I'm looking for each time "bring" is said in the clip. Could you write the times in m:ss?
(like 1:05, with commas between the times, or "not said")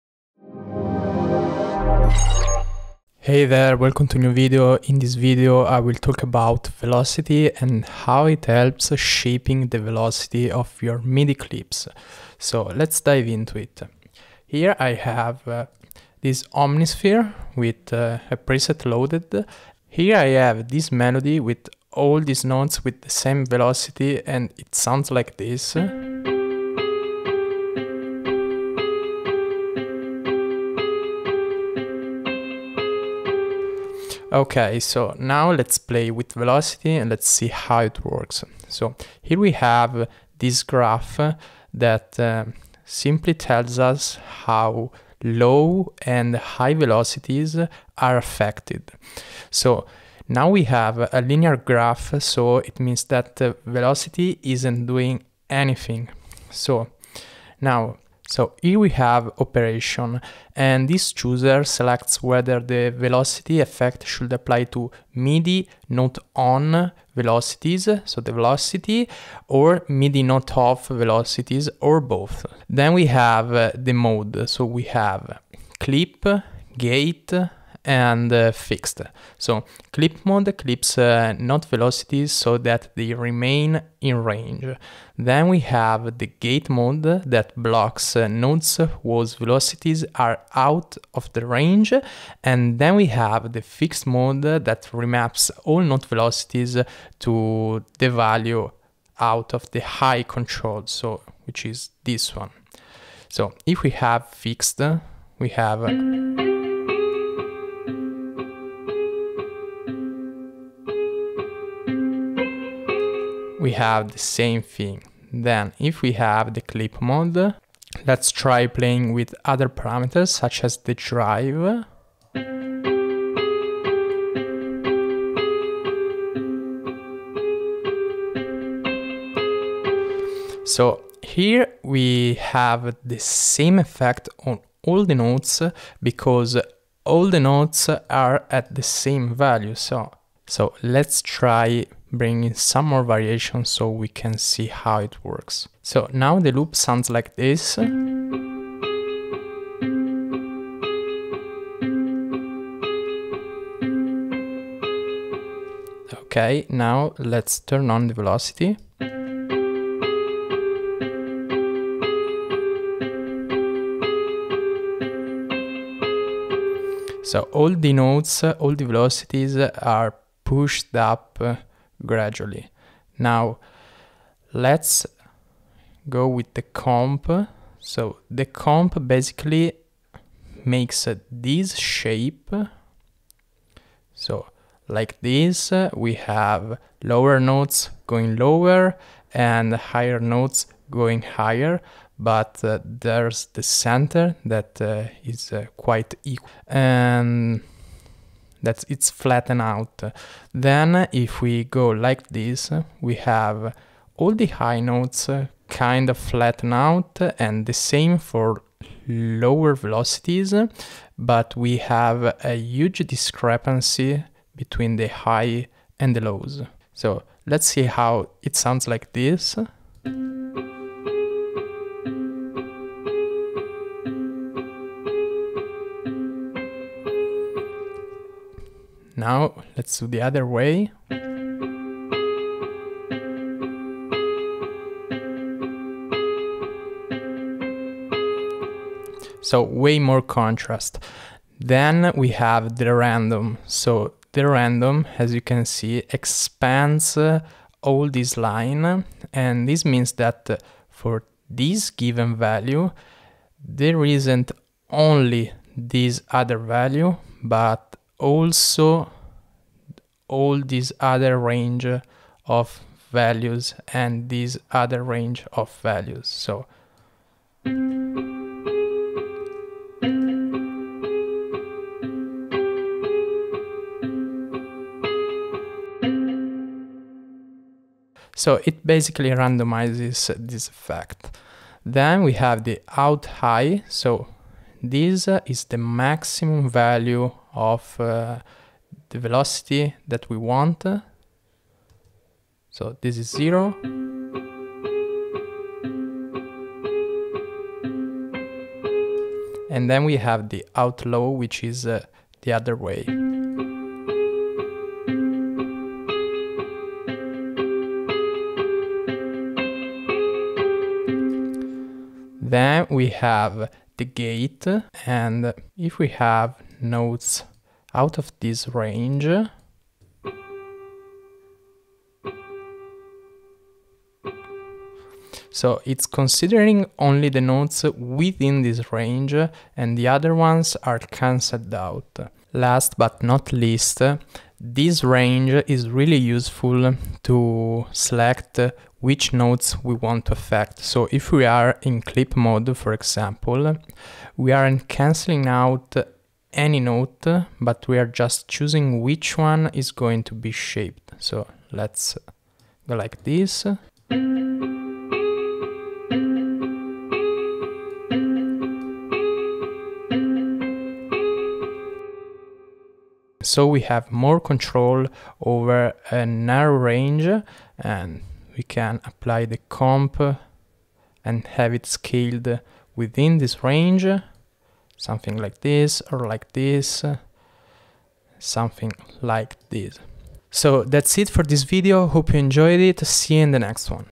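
2:22.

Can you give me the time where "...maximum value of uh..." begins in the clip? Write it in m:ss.
4:45.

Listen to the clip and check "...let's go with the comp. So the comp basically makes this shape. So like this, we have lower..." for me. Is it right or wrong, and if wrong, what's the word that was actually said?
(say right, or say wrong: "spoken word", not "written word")
right.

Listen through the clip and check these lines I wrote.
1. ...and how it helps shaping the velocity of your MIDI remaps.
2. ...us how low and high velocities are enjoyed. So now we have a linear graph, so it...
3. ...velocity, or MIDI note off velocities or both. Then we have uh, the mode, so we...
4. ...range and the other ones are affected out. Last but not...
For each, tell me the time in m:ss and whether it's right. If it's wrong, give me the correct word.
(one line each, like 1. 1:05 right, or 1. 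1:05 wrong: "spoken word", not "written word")
1. 0:07 wrong: "clips", not "remaps"
2. 0:43 wrong: "affected", not "enjoyed"
3. 1:08 right
4. 5:28 wrong: "cancelled", not "affected".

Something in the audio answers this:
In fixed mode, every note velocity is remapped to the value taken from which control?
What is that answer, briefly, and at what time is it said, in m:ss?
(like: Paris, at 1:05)
high control, at 1:39.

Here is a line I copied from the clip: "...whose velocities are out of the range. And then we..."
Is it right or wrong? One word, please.
right.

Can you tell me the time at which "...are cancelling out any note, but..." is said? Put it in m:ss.
5:44.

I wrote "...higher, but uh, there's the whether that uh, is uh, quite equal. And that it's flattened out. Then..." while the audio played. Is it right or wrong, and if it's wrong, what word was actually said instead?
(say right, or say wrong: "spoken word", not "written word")
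wrong: "center", not "whether".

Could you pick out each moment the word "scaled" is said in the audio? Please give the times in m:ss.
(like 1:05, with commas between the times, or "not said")
6:11.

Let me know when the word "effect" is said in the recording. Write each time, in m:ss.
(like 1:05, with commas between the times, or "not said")
1:03, 2:13, 4:40.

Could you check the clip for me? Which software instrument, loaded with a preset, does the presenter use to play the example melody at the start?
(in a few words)
Omnisphere.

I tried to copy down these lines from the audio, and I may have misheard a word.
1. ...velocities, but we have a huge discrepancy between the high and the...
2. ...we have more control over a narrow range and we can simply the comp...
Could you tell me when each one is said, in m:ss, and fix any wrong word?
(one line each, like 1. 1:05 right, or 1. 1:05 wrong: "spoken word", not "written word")
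1. 3:29 right
2. 6:03 wrong: "apply", not "simply".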